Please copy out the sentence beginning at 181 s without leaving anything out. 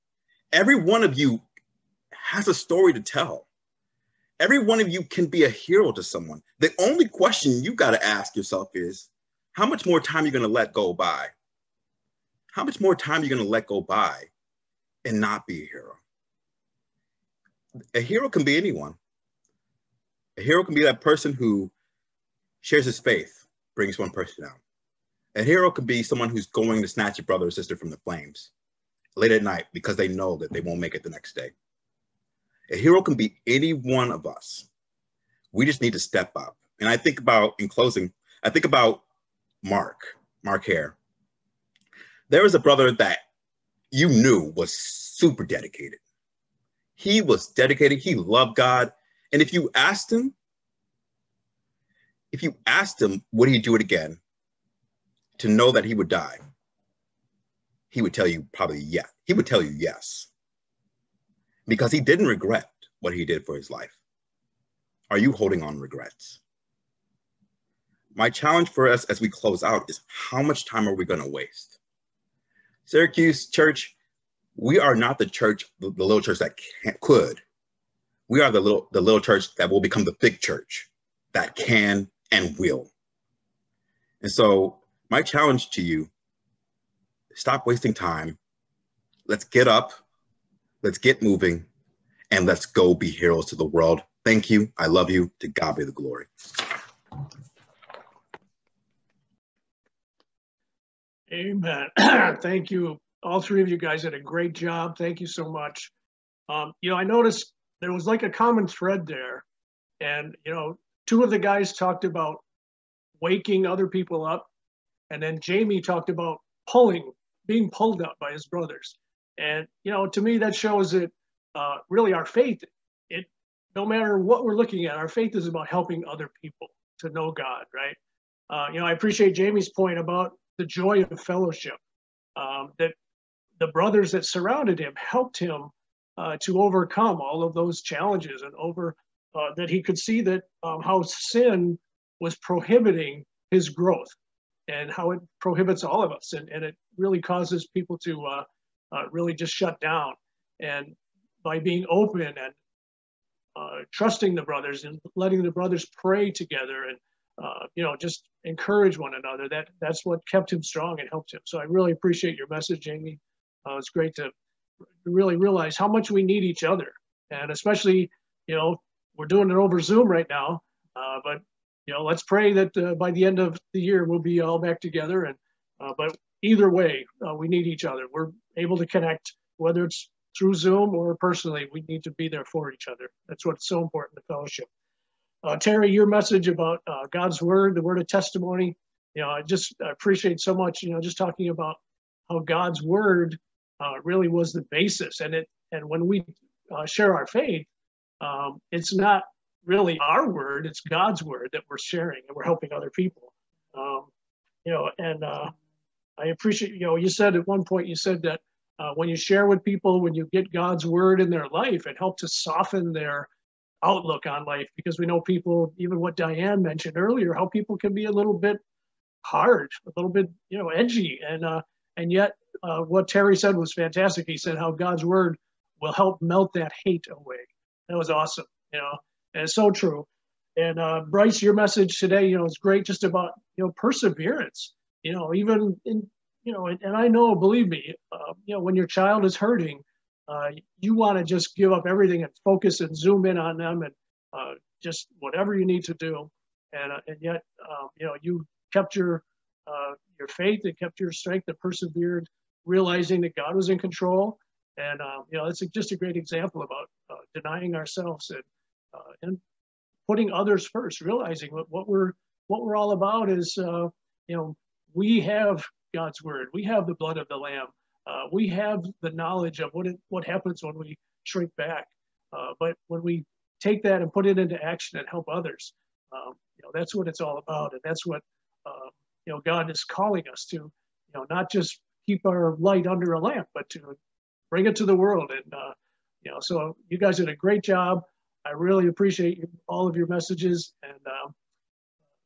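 We need to be there for each other.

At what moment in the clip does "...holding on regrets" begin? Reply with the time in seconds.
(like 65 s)
65 s.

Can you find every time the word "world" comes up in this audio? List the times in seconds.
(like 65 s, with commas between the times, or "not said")
93 s, 284 s.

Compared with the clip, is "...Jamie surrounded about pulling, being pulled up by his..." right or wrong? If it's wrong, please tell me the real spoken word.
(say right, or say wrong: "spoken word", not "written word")
wrong: "talked", not "surrounded".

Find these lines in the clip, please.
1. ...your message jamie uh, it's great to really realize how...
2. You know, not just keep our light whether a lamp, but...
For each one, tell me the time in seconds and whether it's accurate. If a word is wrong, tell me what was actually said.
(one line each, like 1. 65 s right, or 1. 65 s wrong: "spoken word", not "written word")
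1. 162 s right
2. 280 s wrong: "under", not "whether".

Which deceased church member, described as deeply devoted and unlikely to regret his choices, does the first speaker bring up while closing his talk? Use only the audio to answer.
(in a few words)
Mark Hare.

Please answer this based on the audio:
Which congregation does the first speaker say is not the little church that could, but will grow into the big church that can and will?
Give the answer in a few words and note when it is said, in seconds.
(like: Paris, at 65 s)
Syracuse Church, at 72 s.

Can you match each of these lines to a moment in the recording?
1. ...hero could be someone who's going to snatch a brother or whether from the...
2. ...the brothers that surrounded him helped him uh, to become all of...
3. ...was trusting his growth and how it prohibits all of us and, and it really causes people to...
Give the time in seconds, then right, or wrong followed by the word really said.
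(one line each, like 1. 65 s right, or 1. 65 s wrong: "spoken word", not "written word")
1. 25 s wrong: "sister", not "whether"
2. 133 s wrong: "overcome", not "become"
3. 142 s wrong: "prohibiting", not "trusting".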